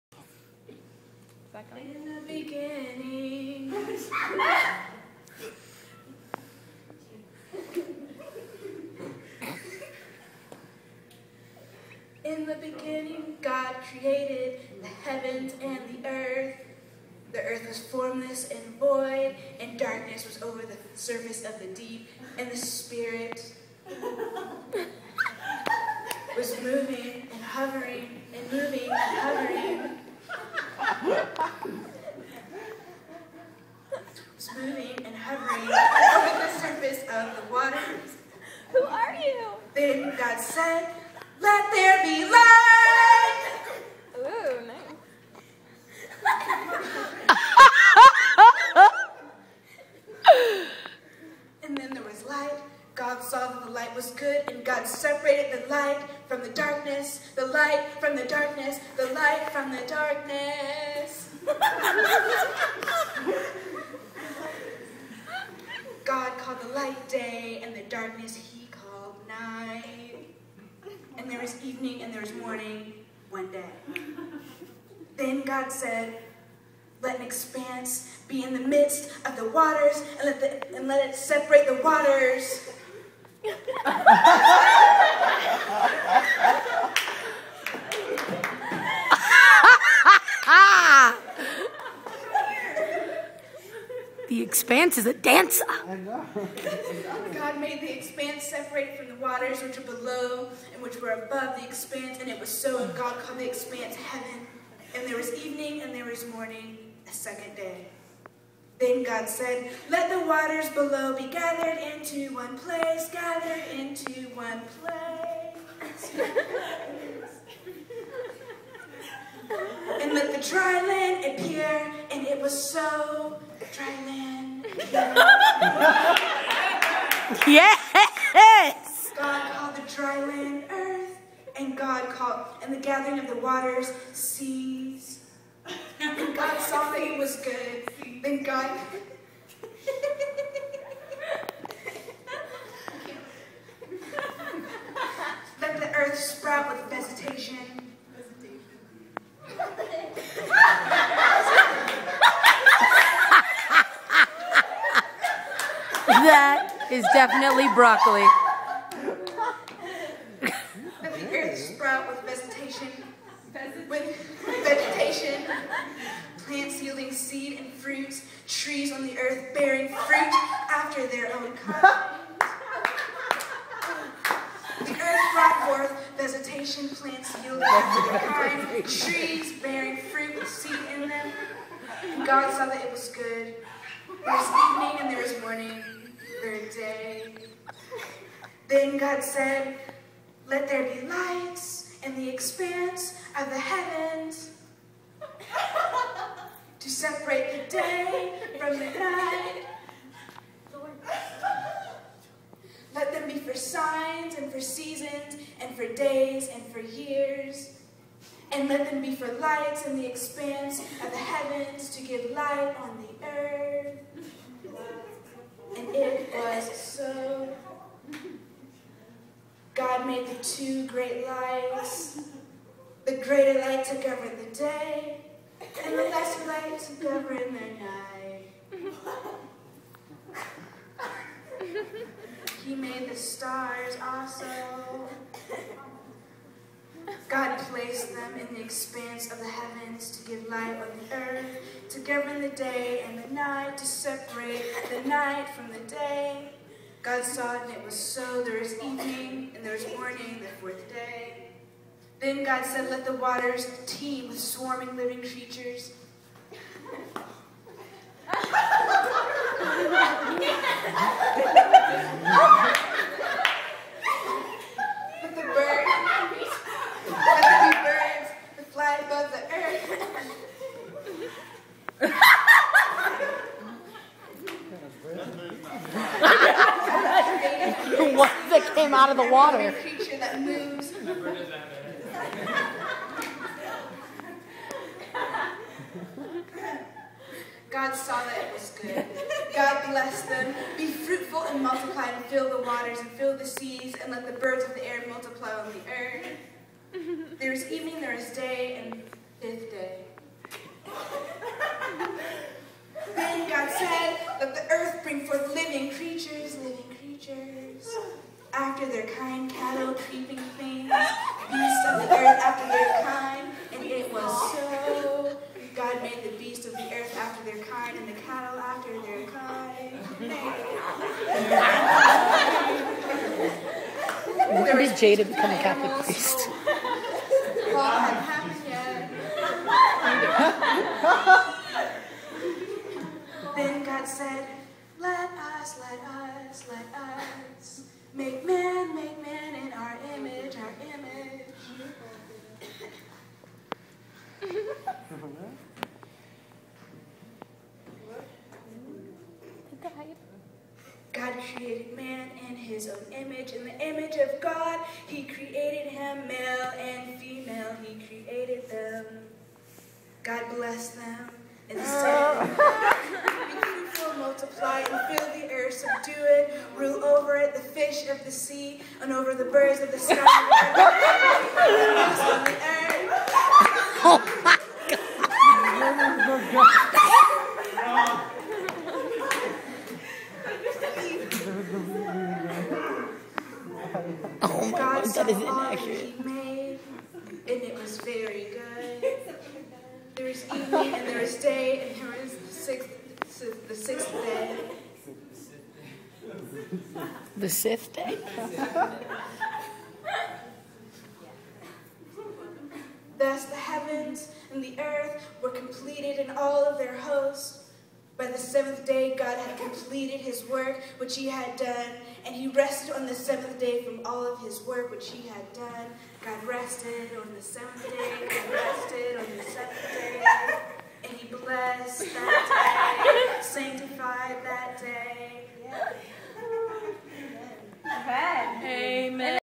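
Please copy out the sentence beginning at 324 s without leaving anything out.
Where is Jada become a Catholic priest?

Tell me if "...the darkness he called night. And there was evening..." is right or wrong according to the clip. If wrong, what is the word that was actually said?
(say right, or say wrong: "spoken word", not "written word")
right.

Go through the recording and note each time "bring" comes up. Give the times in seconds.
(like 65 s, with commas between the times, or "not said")
305 s.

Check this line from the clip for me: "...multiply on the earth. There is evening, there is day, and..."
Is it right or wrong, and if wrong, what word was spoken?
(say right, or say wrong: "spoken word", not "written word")
right.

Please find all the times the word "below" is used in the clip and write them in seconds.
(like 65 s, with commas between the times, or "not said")
99 s, 110 s.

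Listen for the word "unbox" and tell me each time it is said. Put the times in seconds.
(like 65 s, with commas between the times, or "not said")
not said.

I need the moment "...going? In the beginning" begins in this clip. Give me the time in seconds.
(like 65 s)
1 s.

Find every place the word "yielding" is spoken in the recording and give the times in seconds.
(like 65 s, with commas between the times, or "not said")
166 s, 177 s.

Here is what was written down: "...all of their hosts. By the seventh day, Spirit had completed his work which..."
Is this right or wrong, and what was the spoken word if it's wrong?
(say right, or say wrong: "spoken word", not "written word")
wrong: "God", not "Spirit".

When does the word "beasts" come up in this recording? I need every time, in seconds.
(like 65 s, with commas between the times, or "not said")
310 s, 316 s.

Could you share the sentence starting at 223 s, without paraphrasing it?
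The greater light to govern the day, and the lesser light to govern the night.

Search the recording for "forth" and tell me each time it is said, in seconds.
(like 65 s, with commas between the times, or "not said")
175 s, 305 s.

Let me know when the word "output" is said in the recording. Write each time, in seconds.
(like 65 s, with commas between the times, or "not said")
not said.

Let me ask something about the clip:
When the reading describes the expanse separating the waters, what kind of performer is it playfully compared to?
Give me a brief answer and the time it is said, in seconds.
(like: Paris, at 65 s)
a dancer, at 95 s.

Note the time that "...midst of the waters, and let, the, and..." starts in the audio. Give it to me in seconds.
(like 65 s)
78 s.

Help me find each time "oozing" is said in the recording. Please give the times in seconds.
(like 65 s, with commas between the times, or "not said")
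not said.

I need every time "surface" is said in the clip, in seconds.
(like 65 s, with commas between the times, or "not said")
20 s, 36 s.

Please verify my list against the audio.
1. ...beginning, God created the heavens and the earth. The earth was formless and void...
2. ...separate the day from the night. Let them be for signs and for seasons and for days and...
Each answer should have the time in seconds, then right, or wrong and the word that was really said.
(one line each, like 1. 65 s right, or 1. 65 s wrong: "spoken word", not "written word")
1. 12 s right
2. 196 s right.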